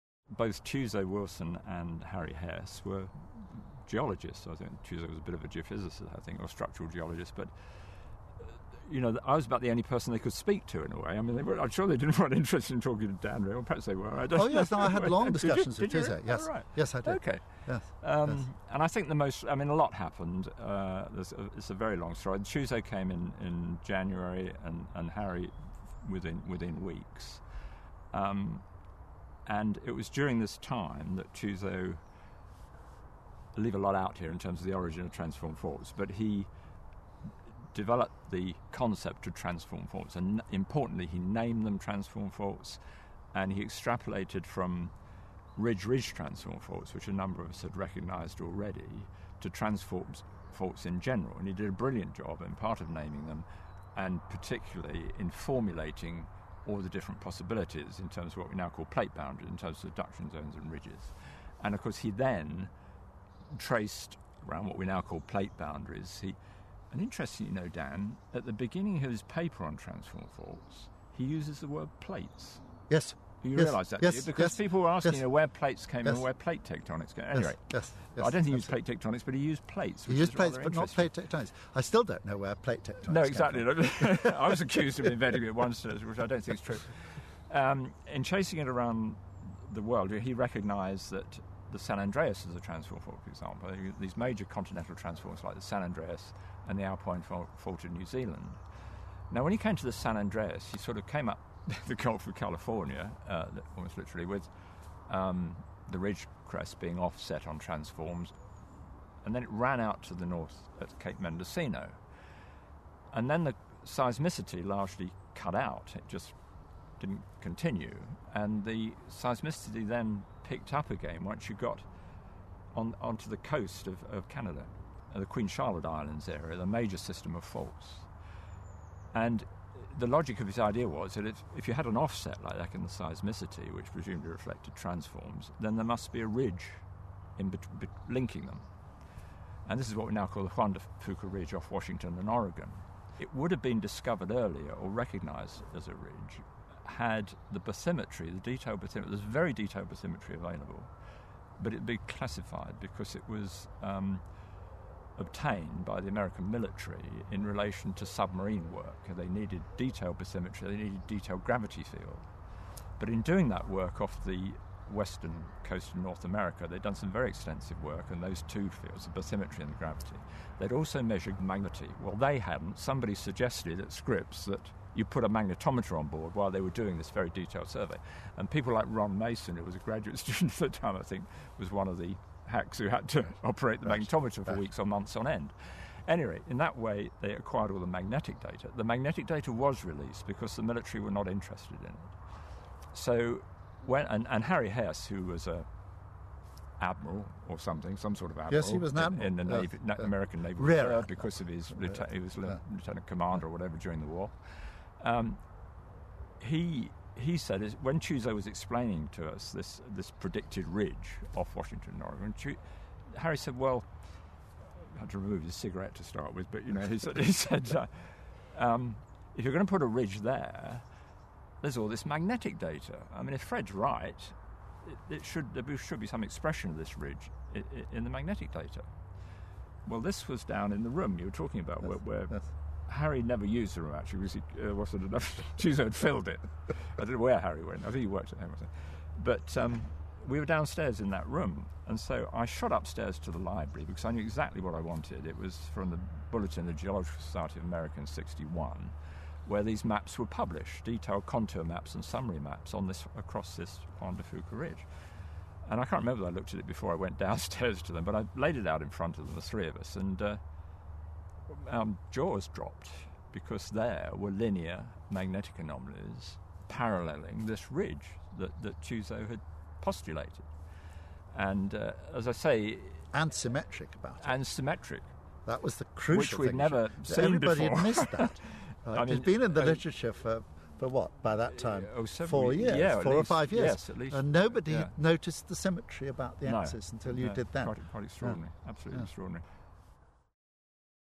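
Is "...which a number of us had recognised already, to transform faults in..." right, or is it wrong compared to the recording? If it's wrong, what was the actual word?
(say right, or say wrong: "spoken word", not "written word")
right.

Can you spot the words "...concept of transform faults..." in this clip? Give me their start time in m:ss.
0:38.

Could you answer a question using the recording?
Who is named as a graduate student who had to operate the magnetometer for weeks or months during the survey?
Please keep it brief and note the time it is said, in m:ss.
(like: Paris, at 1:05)
Ron Mason, at 2:58.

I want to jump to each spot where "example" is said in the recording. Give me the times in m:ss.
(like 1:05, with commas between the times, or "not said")
1:33.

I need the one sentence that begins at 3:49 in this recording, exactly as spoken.
Well, this was down in the room you were talking about, yes, where, where yes.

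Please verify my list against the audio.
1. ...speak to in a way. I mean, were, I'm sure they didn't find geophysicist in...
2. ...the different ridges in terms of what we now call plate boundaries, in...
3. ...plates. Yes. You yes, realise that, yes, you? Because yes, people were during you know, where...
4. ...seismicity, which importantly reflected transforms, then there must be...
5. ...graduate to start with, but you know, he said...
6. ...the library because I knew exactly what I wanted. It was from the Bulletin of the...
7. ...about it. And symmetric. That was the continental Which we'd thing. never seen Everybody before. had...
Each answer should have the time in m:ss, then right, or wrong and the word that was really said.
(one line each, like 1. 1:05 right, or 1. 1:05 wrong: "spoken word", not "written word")
1. 0:10 wrong: "interest", not "geophysicist"
2. 0:56 wrong: "possibilities", not "ridges"
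3. 1:11 wrong: "asking", not "during"
4. 2:12 wrong: "presumably", not "importantly"
5. 3:35 wrong: "cigarette", not "graduate"
6. 4:03 right
7. 4:33 wrong: "crucial", not "continental".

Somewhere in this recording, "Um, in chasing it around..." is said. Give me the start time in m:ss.
1:27.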